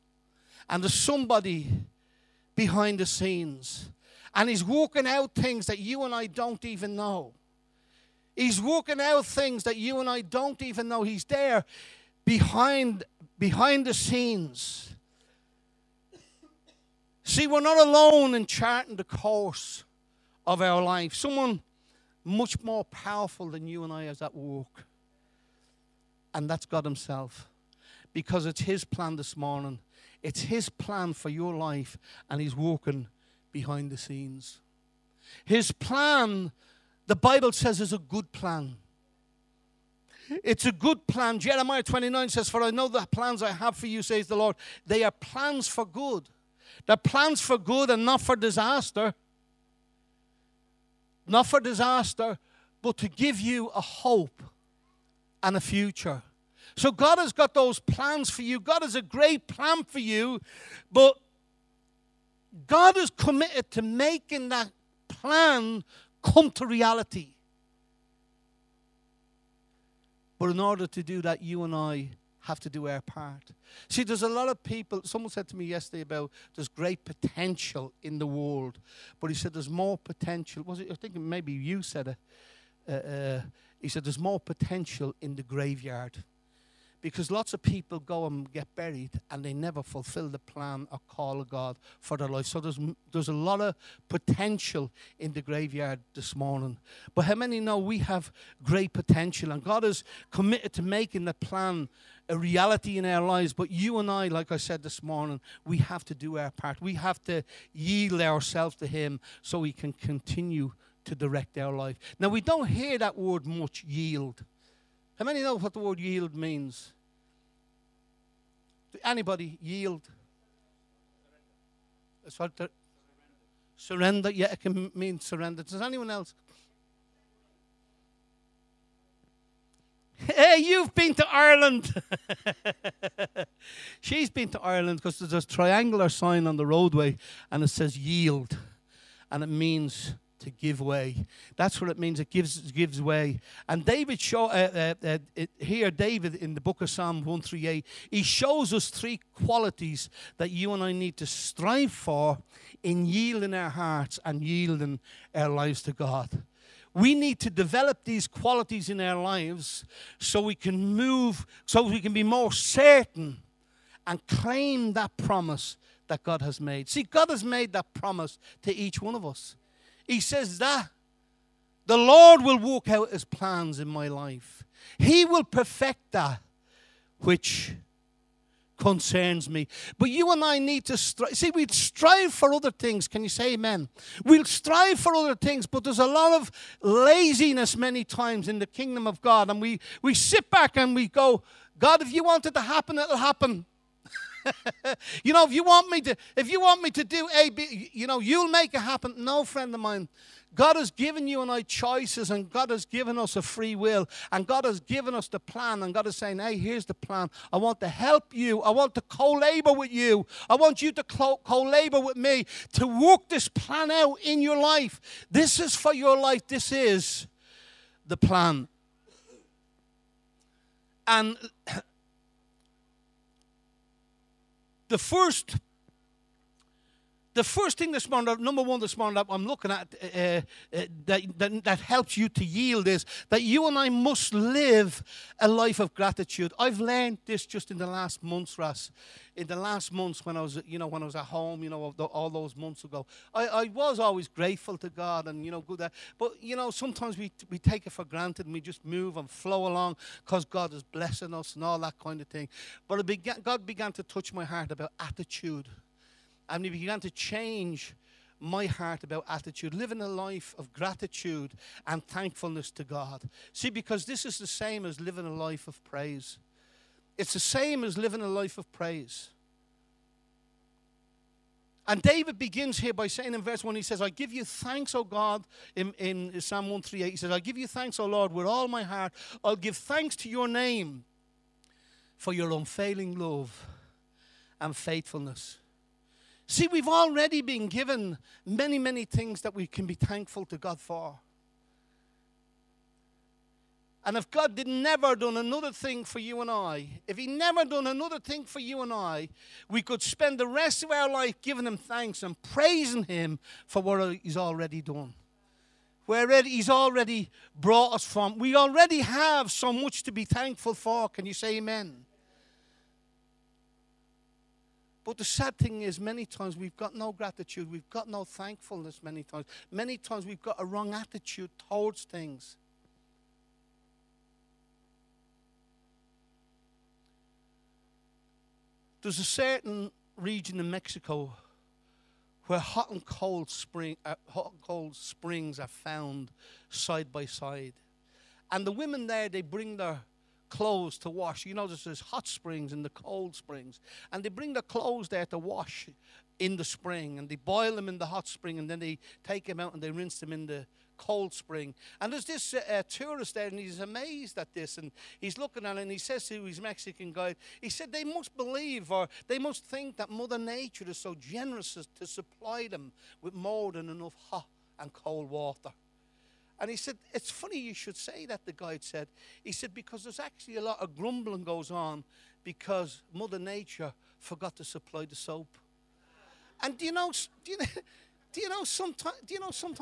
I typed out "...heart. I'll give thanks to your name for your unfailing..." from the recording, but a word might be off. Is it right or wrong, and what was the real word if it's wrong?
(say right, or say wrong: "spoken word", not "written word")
right.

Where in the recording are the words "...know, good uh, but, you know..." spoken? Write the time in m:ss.
4:05.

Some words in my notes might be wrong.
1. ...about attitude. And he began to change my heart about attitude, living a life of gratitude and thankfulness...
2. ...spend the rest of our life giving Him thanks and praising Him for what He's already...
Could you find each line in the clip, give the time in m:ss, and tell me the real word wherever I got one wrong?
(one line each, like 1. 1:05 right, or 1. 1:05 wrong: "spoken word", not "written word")
1. 4:14 right
2. 5:00 right.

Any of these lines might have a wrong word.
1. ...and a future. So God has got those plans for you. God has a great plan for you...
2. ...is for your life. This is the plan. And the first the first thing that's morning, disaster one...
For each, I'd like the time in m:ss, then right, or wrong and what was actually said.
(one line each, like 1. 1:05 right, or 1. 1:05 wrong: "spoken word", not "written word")
1. 0:55 right
2. 3:35 wrong: "number", not "disaster".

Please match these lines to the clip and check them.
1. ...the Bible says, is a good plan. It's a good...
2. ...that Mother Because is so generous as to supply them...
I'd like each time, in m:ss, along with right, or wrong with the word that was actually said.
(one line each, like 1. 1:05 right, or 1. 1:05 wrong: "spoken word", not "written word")
1. 0:37 right
2. 5:59 wrong: "Nature", not "Because".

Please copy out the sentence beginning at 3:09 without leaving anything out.
And we, we sit back and we go, God, if you want it to happen, it'll happen.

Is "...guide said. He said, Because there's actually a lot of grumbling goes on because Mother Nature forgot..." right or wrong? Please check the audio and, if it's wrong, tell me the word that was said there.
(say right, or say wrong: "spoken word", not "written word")
right.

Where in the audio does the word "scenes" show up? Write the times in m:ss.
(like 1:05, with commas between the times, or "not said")
0:03, 0:13, 0:33.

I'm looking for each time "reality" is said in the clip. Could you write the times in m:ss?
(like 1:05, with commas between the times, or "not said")
1:06, 1:42.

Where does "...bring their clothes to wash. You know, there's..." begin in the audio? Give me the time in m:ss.
5:39.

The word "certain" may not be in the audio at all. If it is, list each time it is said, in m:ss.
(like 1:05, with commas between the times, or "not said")
2:42, 5:29.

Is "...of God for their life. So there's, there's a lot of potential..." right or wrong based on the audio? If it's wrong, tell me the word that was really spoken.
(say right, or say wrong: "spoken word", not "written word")
right.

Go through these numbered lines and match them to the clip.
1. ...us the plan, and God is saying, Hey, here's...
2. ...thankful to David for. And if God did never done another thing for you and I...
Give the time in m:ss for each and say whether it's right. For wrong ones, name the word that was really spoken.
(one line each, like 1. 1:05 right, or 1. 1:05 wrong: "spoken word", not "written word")
1. 3:25 right
2. 4:49 wrong: "God", not "David".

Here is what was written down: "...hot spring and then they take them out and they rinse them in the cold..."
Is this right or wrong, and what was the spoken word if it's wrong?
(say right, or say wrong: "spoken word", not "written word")
right.